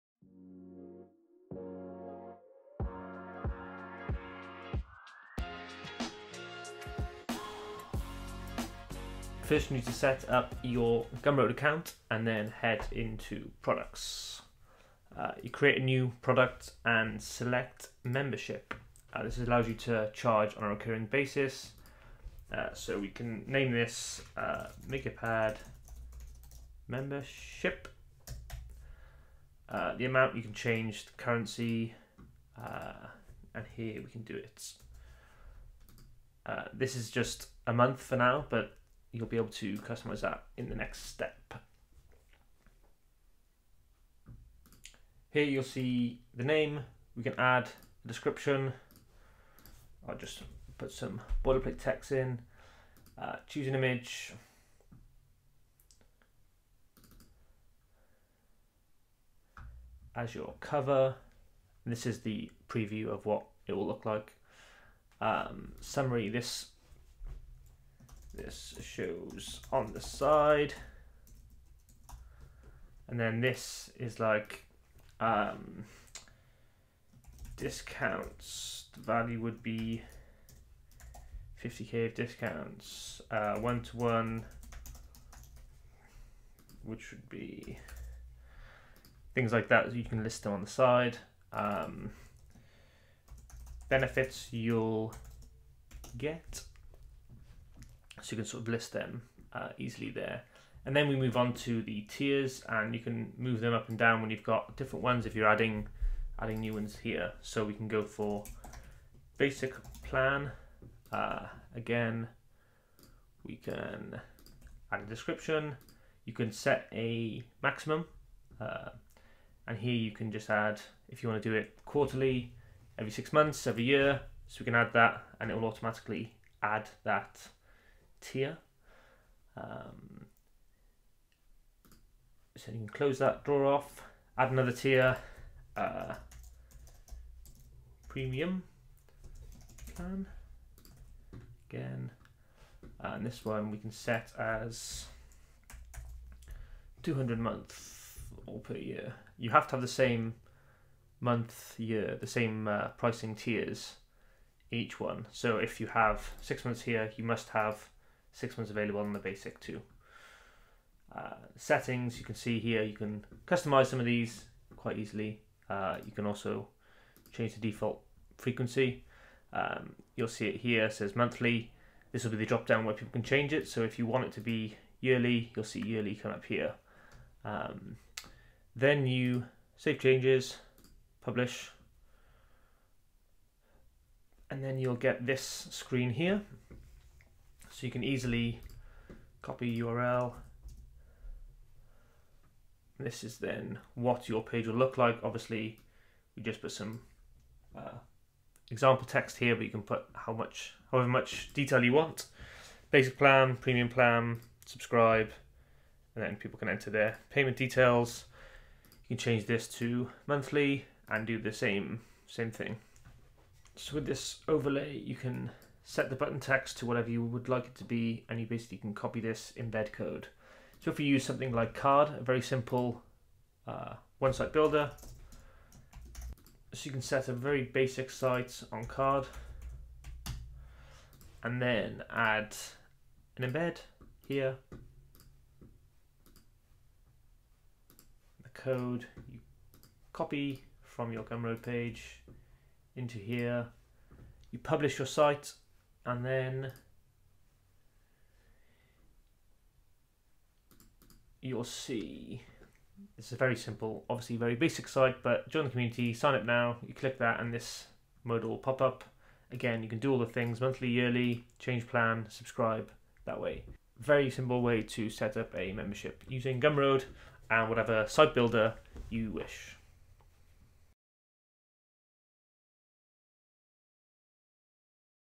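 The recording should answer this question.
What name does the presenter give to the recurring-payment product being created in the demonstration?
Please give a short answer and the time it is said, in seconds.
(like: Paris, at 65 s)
MakerPad membership, at 24 s.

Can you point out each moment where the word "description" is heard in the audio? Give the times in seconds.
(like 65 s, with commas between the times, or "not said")
48 s, 115 s.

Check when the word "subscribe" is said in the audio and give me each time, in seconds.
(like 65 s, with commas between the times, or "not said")
204 s, 262 s.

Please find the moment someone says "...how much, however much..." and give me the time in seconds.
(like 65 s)
200 s.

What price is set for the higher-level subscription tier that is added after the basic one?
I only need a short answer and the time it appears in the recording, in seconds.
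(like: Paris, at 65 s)
200, at 147 s.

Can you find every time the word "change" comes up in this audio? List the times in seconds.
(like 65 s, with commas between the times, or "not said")
30 s, 167 s, 173 s, 179 s, 209 s, 261 s.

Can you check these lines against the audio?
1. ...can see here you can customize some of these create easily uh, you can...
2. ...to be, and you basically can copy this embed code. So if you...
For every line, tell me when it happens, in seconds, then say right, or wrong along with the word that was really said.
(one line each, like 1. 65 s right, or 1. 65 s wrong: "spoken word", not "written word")
1. 162 s wrong: "quite", not "create"
2. 217 s right.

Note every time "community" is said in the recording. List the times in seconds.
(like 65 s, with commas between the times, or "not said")
255 s.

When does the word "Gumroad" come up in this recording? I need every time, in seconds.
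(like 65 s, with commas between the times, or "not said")
11 s, 241 s, 266 s.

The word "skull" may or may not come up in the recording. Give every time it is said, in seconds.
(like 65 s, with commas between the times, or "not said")
not said.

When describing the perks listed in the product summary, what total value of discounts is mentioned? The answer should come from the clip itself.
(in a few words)
50k.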